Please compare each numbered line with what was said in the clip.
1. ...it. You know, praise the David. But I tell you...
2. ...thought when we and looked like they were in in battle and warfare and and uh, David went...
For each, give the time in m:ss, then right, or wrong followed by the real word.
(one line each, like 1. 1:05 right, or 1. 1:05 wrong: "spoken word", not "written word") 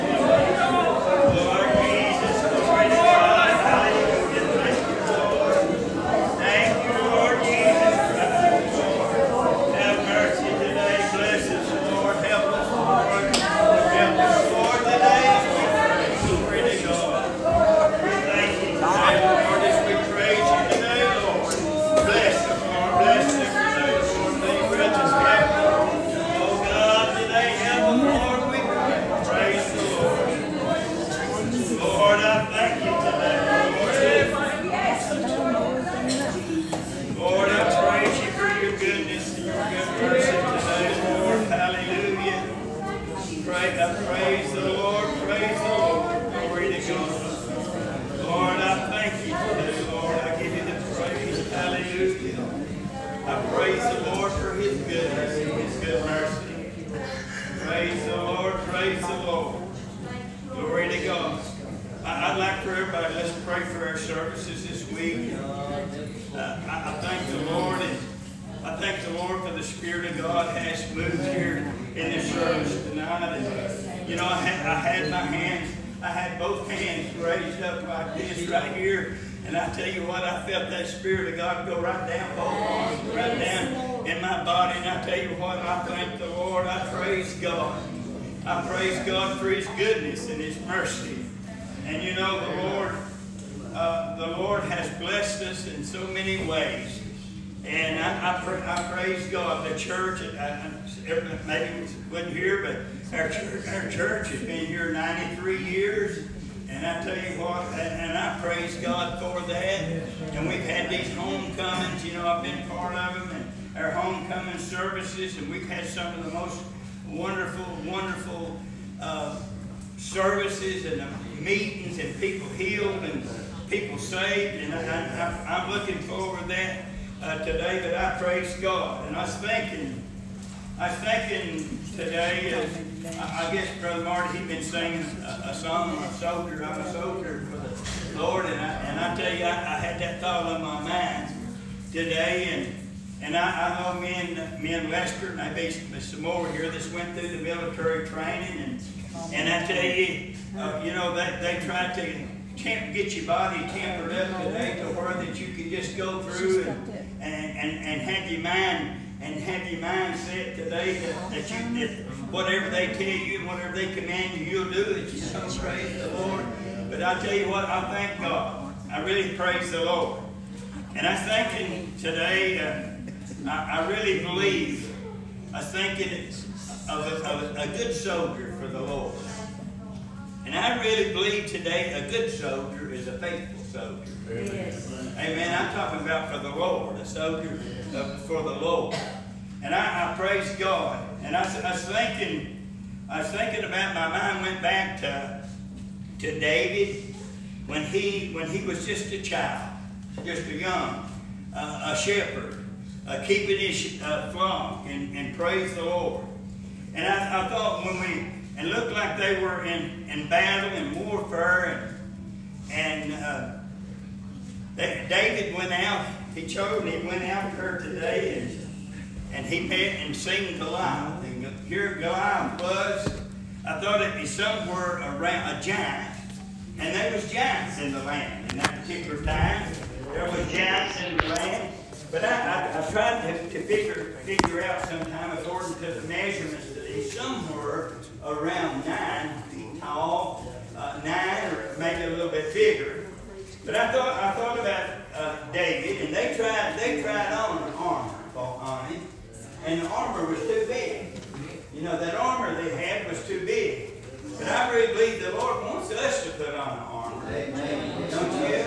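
1. 2:44 wrong: "Lord", not "David"
2. 3:27 right.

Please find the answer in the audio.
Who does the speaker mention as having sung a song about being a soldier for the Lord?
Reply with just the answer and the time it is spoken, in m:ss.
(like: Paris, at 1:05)
Brother Marty, at 2:13.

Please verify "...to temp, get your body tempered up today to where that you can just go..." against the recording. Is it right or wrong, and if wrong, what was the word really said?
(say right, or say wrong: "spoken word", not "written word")
right.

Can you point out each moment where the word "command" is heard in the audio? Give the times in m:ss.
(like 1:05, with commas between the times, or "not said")
2:43.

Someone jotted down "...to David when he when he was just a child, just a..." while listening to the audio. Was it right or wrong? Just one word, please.
right.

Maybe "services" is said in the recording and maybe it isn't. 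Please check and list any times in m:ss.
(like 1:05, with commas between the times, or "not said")
1:54, 1:59.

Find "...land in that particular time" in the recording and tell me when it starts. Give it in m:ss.
3:48.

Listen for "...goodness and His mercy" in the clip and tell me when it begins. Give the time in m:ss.
1:29.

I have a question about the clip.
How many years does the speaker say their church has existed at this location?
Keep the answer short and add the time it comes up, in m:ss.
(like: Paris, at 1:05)
93 years, at 1:44.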